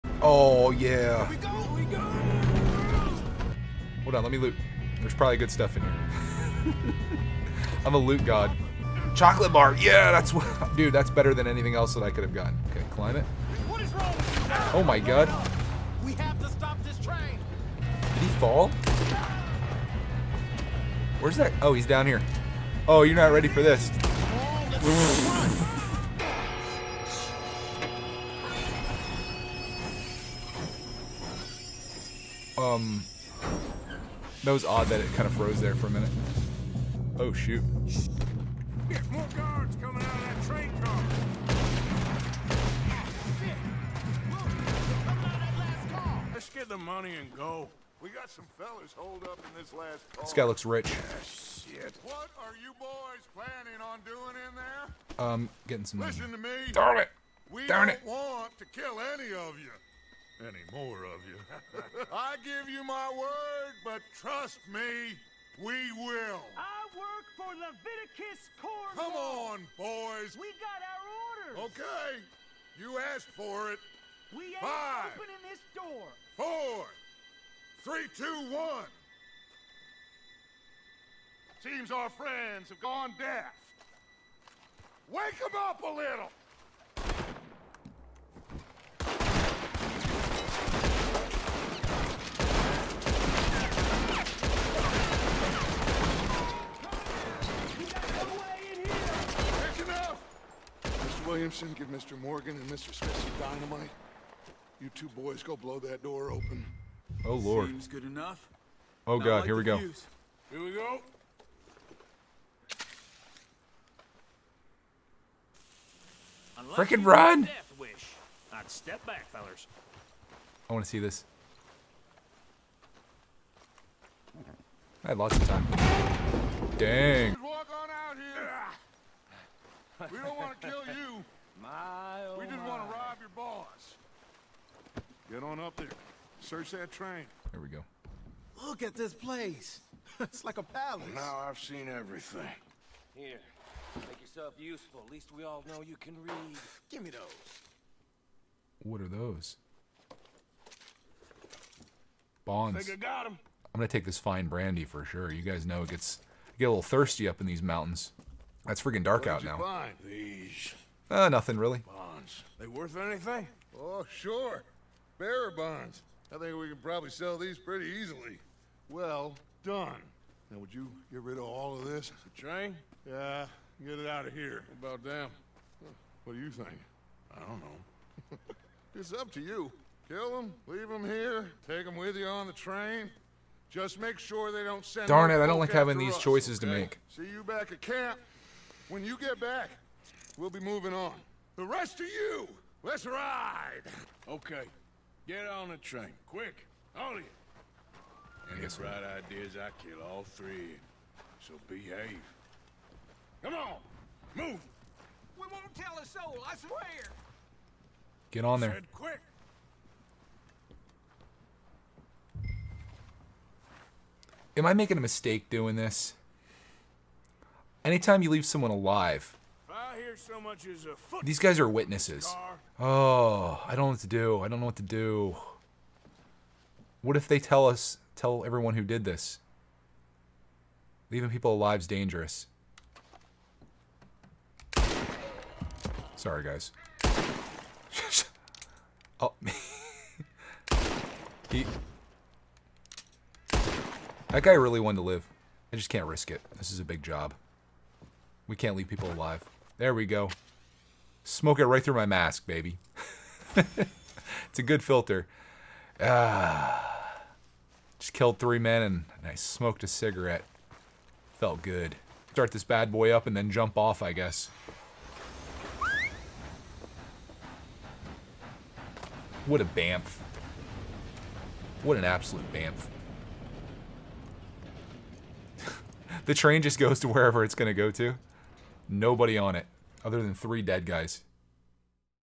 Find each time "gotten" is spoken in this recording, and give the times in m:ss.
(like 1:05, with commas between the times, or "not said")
0:12.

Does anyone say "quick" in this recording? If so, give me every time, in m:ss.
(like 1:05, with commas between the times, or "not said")
3:16, 3:28.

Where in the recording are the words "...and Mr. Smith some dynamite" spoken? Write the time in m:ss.
1:42.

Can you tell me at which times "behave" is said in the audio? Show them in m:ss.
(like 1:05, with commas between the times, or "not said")
3:21.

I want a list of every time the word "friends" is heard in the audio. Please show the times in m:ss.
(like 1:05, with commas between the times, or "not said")
1:22.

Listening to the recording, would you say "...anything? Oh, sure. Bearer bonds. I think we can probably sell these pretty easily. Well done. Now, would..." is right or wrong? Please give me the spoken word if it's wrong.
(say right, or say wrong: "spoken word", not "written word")
right.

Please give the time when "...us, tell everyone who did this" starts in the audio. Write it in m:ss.
3:47.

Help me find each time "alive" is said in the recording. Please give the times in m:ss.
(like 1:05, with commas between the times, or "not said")
3:38, 3:51, 4:09.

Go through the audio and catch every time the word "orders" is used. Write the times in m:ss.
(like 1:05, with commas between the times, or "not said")
1:11.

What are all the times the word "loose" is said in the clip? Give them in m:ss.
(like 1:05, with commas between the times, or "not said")
not said.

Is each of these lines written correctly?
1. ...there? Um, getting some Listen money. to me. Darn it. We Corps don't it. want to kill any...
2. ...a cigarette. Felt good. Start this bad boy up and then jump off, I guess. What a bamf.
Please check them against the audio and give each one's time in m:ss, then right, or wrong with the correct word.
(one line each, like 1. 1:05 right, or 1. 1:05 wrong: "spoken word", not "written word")
1. 0:54 wrong: "Darn", not "Corps"
2. 4:19 right.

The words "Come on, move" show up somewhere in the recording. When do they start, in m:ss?
3:23.